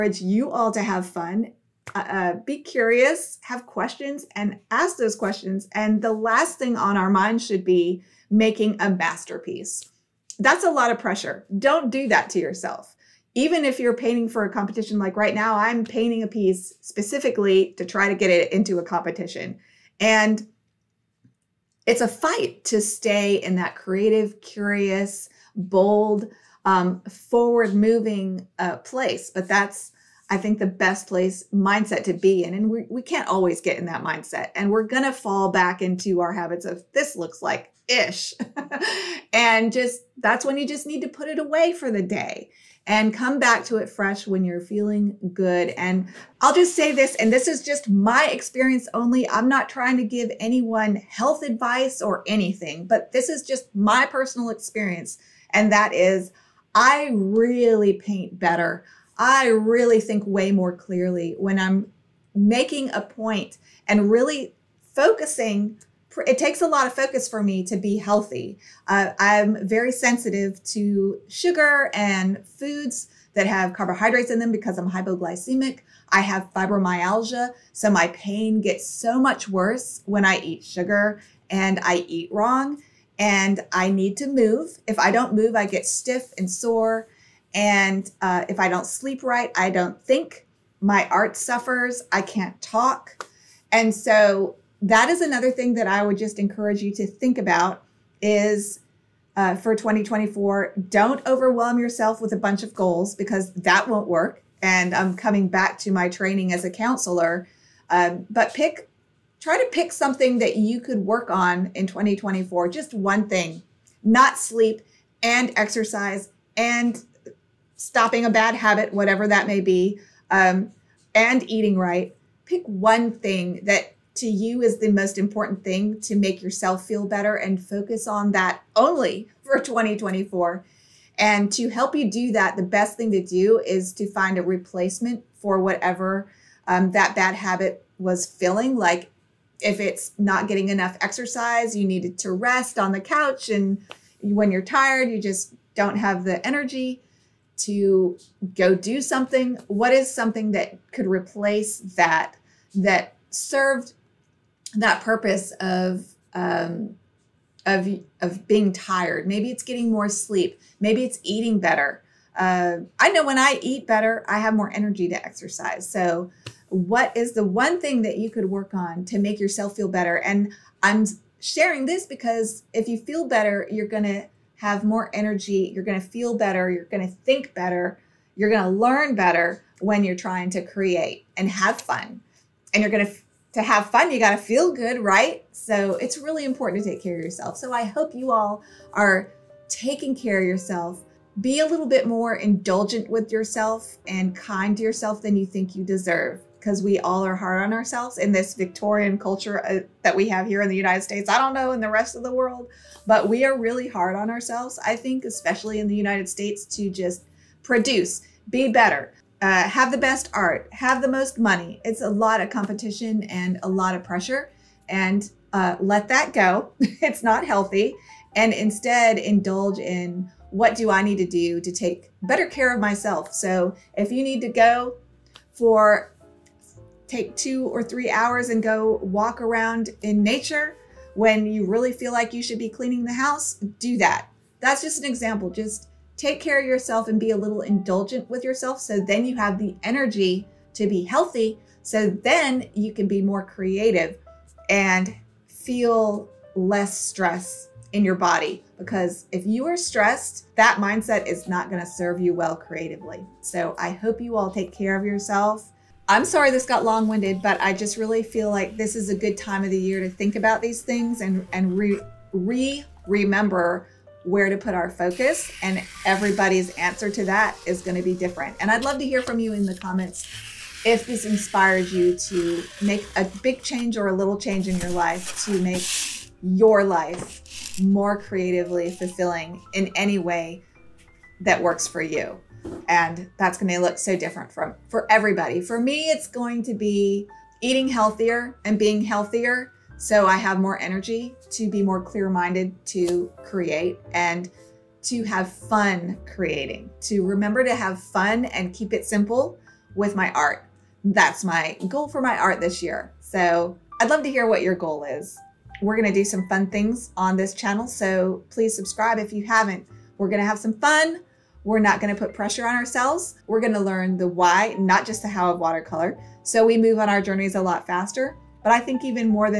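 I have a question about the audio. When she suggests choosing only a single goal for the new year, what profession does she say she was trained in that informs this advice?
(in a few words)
counselor.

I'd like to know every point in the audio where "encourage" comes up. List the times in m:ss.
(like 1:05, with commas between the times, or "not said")
1:36.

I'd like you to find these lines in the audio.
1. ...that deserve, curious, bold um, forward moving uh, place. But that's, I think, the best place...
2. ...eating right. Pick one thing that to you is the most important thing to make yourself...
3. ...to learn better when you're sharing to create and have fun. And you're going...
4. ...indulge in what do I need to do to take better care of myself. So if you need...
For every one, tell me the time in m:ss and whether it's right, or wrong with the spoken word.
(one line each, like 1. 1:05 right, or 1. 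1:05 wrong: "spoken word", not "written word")
1. 0:23 wrong: "creative", not "deserve"
2. 2:01 right
3. 2:58 wrong: "trying", not "sharing"
4. 3:39 right.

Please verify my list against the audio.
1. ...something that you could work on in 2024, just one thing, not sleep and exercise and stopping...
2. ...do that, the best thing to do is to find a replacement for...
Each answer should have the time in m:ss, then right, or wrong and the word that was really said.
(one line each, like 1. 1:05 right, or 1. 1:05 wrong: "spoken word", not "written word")
1. 1:49 right
2. 2:12 right.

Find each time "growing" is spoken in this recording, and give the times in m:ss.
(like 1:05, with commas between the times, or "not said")
not said.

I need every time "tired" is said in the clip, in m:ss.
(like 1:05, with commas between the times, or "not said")
2:24, 2:38.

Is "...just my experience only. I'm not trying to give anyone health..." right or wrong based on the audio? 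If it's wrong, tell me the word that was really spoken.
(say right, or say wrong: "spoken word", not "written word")
right.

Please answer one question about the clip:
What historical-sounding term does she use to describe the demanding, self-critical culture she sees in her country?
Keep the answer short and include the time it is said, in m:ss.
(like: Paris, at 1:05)
Victorian, at 3:18.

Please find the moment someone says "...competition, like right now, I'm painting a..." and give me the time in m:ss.
0:14.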